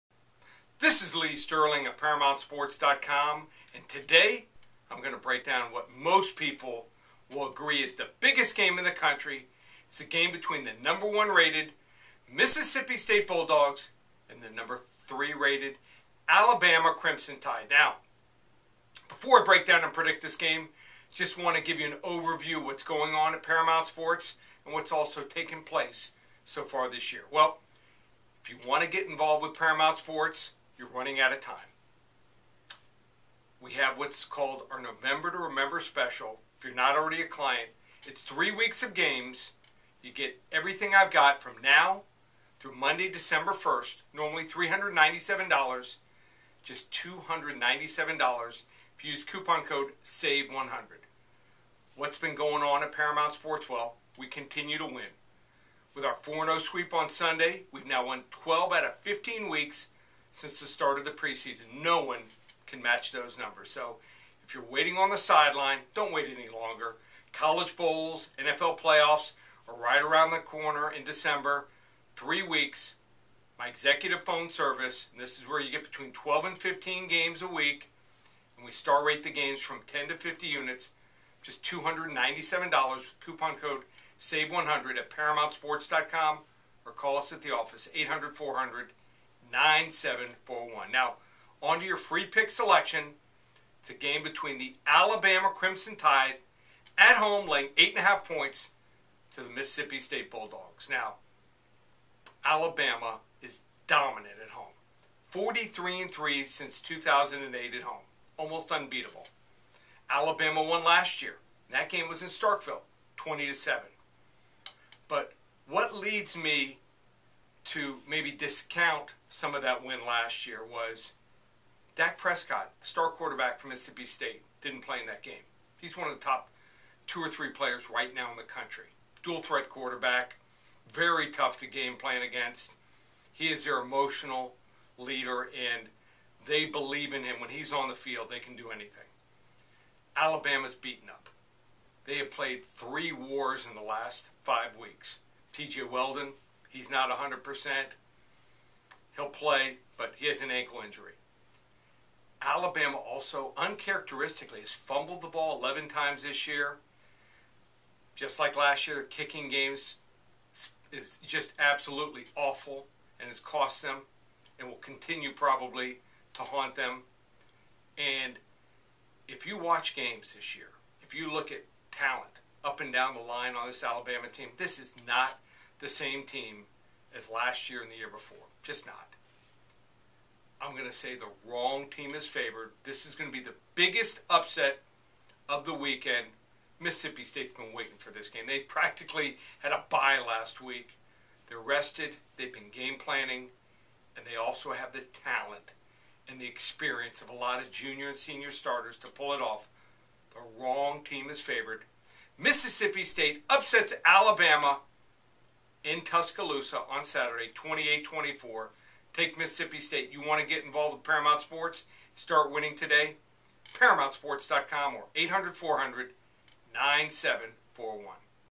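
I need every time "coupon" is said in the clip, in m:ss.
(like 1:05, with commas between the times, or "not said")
0:49, 1:23.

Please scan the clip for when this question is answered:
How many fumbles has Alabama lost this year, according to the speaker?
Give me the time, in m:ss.
2:35.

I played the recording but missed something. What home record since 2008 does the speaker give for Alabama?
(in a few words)
43 and 3.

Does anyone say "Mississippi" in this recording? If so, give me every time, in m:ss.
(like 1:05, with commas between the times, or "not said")
0:12, 1:39, 2:03, 3:06, 3:22, 3:29.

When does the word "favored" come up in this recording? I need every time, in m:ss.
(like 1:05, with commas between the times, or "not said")
3:02, 3:21.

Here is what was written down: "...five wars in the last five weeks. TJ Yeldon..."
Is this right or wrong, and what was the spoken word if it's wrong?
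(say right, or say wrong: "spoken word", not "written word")
wrong: "three", not "five".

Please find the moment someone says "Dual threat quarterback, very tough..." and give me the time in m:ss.
2:09.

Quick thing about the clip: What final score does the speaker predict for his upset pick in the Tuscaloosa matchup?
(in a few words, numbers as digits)
28-24.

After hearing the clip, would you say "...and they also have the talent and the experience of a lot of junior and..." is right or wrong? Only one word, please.
right.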